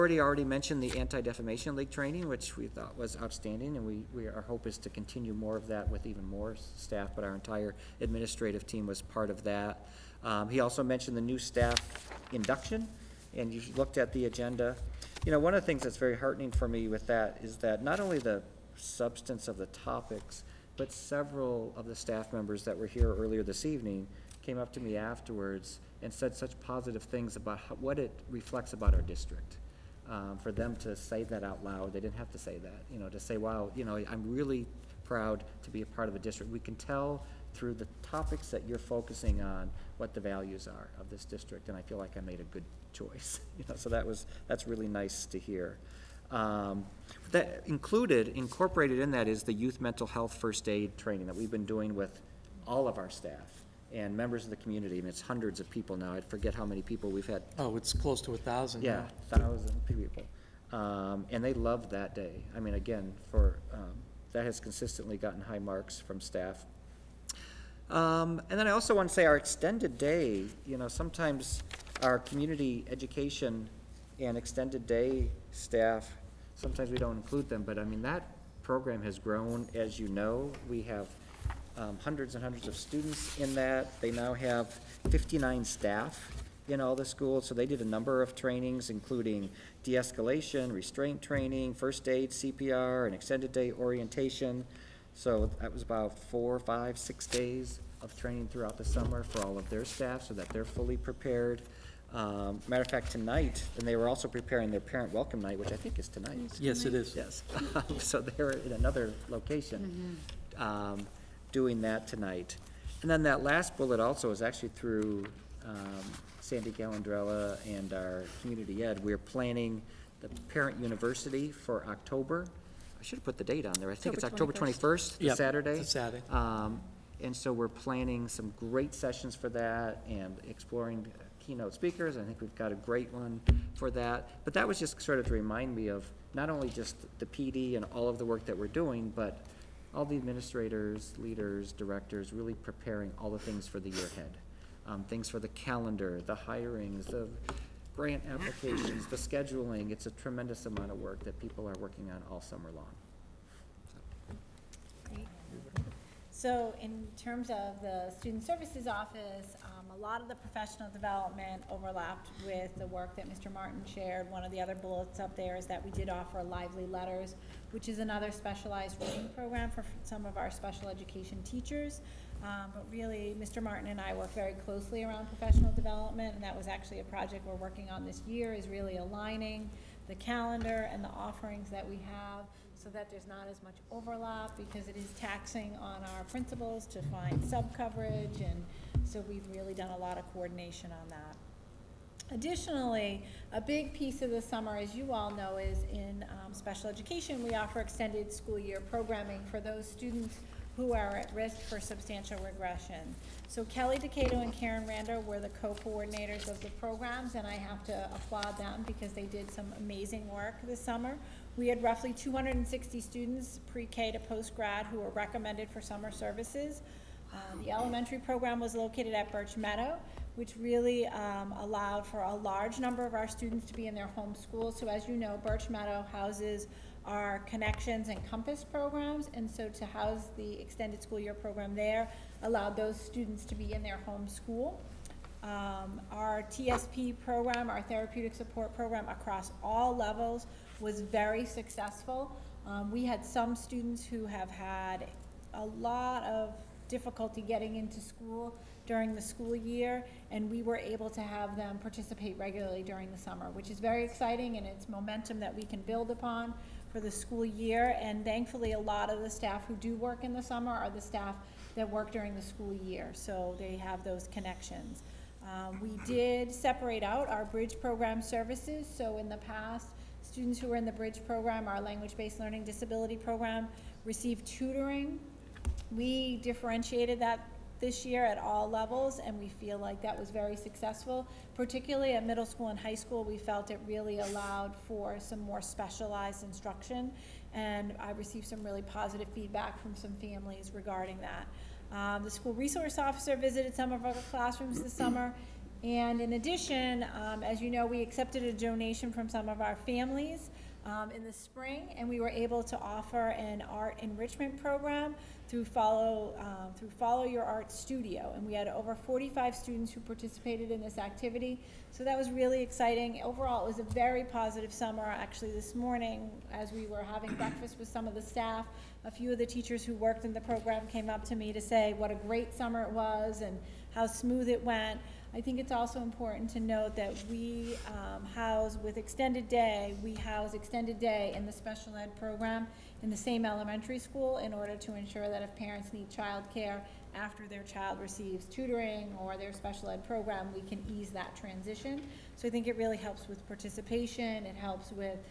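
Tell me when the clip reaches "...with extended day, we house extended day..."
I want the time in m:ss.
5:28.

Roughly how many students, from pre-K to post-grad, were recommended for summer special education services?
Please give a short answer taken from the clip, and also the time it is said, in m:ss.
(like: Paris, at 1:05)
260, at 3:32.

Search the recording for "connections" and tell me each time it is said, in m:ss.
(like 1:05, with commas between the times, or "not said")
3:47, 4:24.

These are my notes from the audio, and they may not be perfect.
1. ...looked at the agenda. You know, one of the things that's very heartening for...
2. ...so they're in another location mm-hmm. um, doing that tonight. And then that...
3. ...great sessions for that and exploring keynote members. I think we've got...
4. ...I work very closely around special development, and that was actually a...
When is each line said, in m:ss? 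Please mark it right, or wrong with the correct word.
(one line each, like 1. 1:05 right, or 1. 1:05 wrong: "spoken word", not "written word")
1. 0:13 right
2. 1:47 right
3. 2:08 wrong: "speakers", not "members"
4. 2:54 wrong: "professional", not "special".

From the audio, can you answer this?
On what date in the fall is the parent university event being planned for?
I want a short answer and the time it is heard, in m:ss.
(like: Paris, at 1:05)
October 21st, at 2:04.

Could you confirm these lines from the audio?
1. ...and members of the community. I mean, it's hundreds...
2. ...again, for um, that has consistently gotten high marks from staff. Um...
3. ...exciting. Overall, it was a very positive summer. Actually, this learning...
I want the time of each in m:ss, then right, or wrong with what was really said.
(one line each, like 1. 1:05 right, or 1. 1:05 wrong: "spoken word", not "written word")
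1. 0:53 right
2. 1:02 right
3. 5:12 wrong: "morning", not "learning".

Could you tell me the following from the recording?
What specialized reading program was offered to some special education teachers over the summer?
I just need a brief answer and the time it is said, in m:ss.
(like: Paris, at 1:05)
Lively Letters, at 2:46.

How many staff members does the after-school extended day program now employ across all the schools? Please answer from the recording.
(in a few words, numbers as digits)
59.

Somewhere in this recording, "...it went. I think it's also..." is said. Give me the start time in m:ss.
5:24.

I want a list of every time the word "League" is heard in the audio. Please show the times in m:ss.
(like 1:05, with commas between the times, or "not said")
0:01.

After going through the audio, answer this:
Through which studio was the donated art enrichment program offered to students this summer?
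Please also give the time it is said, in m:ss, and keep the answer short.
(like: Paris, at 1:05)
Follow Your Art Studio, at 5:06.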